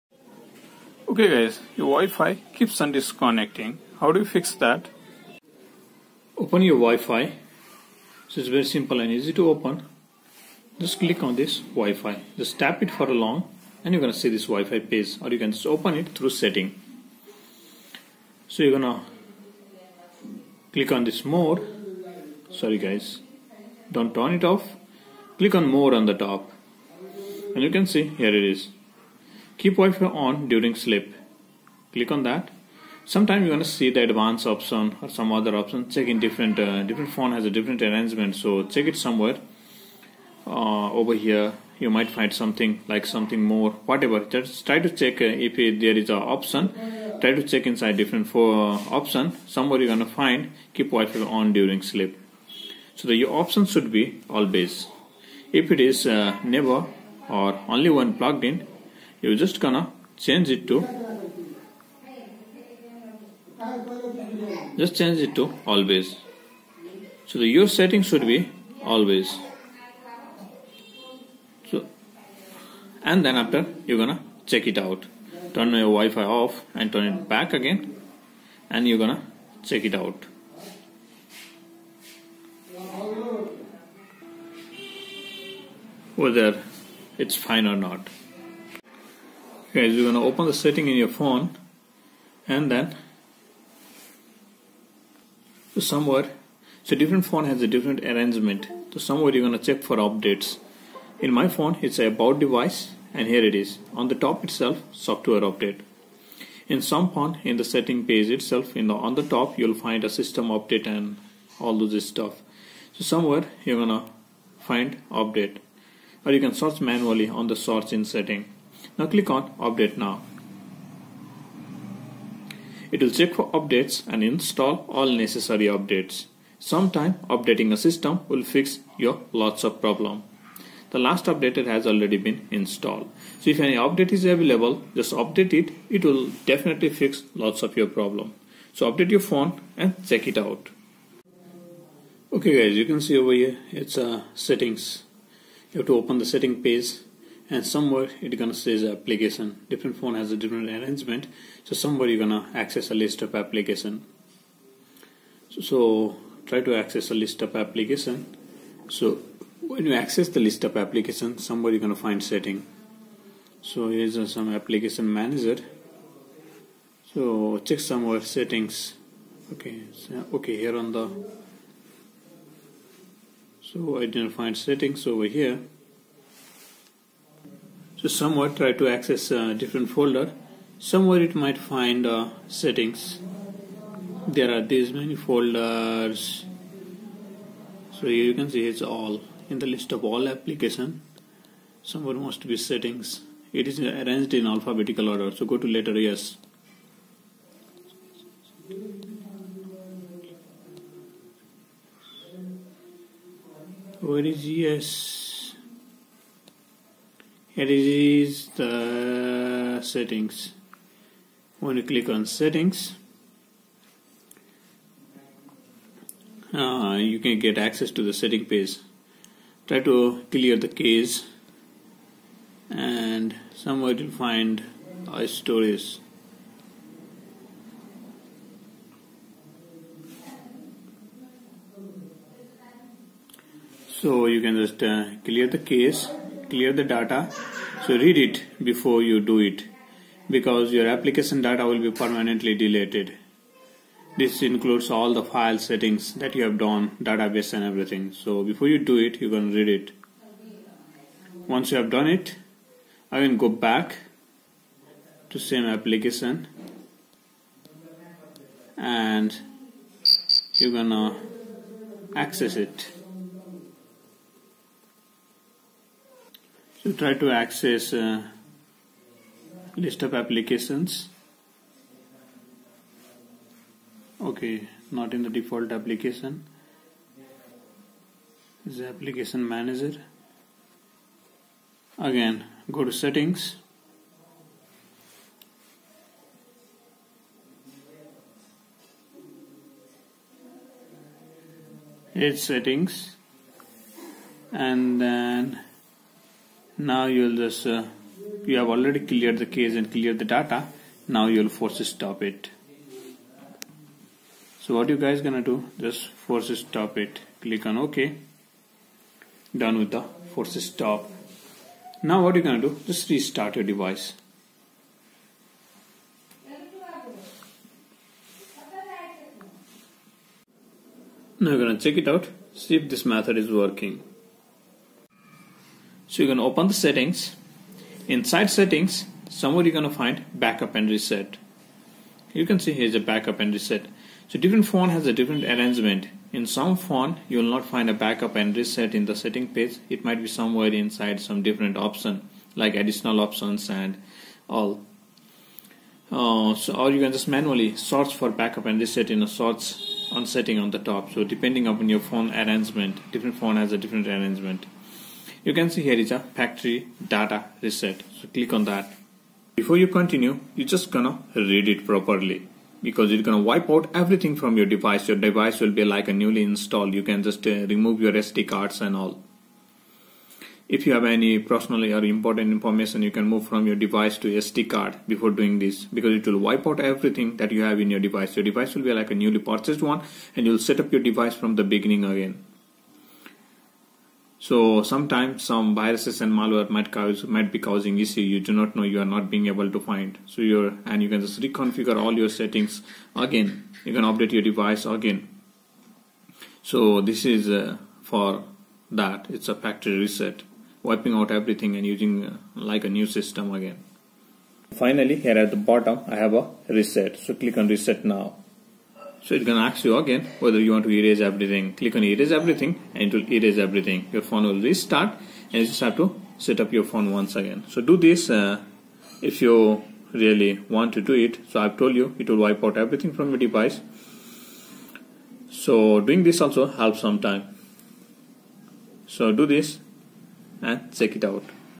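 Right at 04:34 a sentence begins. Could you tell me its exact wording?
Okay, not in the default application.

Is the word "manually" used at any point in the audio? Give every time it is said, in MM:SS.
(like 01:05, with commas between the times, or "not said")
01:56, 05:47.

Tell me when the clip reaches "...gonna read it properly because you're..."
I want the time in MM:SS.
06:00.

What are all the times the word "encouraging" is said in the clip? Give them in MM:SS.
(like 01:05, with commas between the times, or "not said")
not said.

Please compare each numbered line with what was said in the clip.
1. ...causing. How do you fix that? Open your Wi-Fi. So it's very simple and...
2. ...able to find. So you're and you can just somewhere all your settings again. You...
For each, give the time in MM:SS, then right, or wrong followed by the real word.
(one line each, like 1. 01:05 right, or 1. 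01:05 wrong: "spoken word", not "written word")
1. 00:02 wrong: "disconnecting", not "causing"
2. 06:29 wrong: "reconfigure", not "somewhere".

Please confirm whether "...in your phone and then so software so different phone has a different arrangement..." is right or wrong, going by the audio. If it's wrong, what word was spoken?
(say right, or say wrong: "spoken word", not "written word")
wrong: "somewhere", not "software".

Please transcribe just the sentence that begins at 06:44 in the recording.
Finally, here at the bottom, I have a reset.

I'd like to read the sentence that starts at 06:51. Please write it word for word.
Click on erase everything and it will erase everything.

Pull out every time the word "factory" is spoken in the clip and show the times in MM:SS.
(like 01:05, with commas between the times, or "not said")
05:56, 06:39.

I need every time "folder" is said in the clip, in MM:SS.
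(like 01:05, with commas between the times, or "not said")
02:59, 03:05.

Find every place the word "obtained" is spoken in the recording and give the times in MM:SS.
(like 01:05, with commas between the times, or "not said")
not said.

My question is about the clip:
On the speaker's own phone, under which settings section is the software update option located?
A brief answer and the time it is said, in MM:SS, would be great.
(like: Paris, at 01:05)
About device, at 01:41.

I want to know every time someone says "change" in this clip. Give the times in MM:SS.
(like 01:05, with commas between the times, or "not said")
01:00, 01:04.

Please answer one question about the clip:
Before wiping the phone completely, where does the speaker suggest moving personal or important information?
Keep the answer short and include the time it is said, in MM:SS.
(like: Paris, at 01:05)
SD card, at 06:13.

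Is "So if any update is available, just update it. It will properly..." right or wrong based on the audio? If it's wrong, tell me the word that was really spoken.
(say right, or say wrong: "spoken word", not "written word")
wrong: "definitely", not "properly".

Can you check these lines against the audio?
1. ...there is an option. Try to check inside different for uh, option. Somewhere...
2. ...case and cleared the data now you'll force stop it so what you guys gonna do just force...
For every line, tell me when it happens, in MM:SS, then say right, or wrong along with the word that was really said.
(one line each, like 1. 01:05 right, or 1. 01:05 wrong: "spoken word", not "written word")
1. 00:45 right
2. 04:59 right.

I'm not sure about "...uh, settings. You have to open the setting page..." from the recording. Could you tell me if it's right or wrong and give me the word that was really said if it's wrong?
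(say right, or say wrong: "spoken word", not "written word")
right.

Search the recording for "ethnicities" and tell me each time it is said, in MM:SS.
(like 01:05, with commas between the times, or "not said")
not said.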